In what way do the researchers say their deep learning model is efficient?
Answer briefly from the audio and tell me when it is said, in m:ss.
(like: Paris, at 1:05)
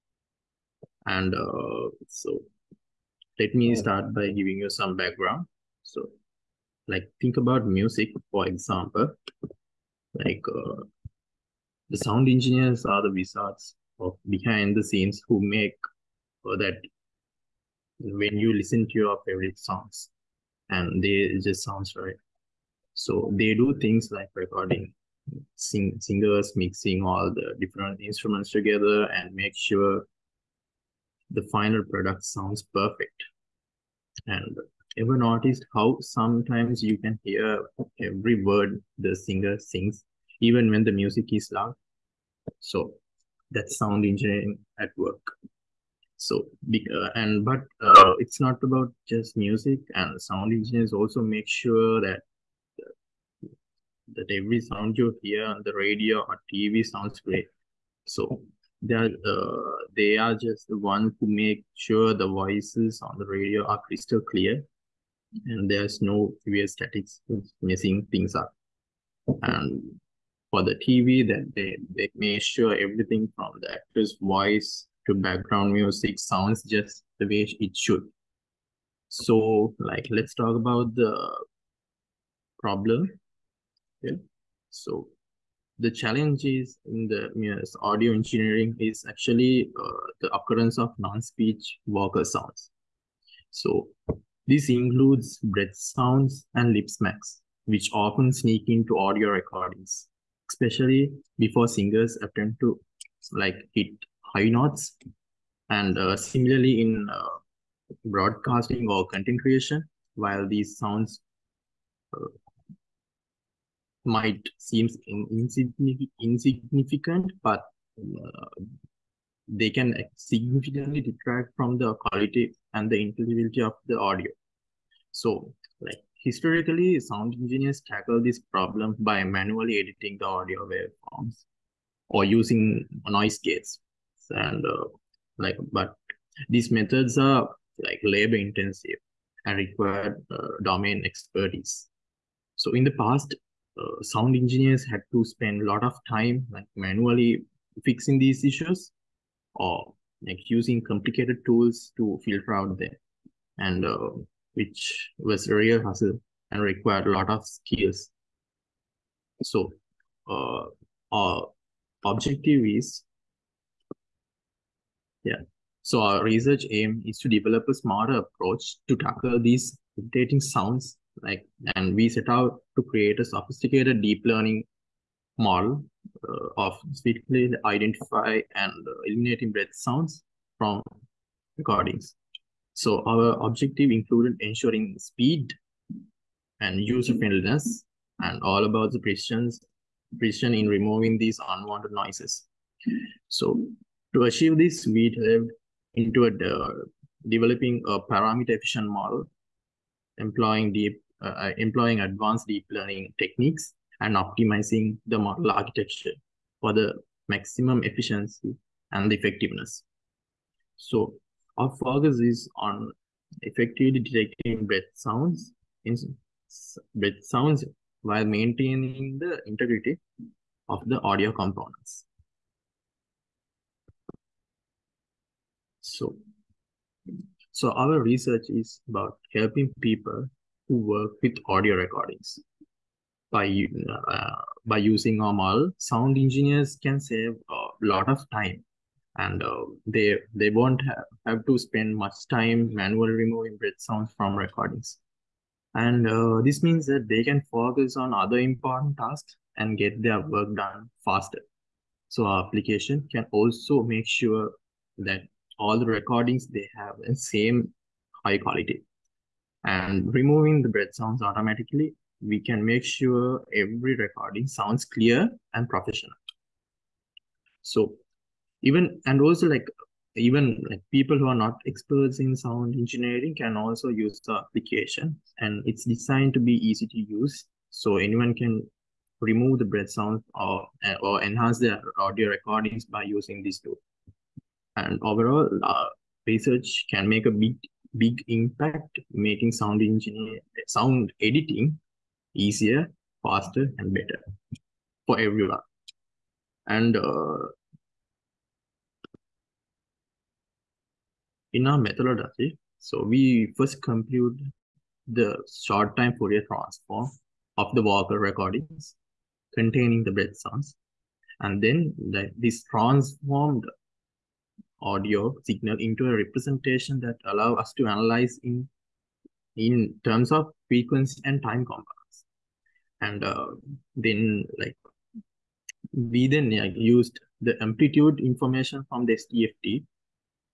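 parameter-efficient, at 3:18.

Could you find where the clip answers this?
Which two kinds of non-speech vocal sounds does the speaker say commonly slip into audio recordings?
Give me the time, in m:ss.
1:35.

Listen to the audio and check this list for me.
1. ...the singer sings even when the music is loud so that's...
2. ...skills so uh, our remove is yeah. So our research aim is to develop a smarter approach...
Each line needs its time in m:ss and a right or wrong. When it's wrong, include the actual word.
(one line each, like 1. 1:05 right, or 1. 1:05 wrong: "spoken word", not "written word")
1. 0:38 right
2. 2:37 wrong: "objective", not "remove".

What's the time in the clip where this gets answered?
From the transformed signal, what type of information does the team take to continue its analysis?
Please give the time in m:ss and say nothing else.
5:27.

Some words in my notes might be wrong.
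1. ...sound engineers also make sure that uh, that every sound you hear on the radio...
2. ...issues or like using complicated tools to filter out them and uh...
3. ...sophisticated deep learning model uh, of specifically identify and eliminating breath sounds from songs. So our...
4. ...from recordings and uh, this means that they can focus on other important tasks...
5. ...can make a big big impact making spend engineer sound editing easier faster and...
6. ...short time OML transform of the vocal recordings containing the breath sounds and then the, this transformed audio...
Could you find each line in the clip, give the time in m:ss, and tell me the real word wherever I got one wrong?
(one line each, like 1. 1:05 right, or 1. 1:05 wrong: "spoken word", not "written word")
1. 0:50 right
2. 2:28 right
3. 2:53 wrong: "recordings", not "songs"
4. 4:04 right
5. 4:46 wrong: "sound", not "spend"
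6. 5:05 wrong: "Fourier", not "OML".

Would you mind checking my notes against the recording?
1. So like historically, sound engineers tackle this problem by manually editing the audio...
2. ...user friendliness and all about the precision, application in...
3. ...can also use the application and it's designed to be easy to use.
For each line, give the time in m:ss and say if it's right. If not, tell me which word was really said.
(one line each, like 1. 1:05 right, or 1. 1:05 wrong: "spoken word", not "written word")
1. 2:05 right
2. 3:06 wrong: "precision", not "application"
3. 4:33 right.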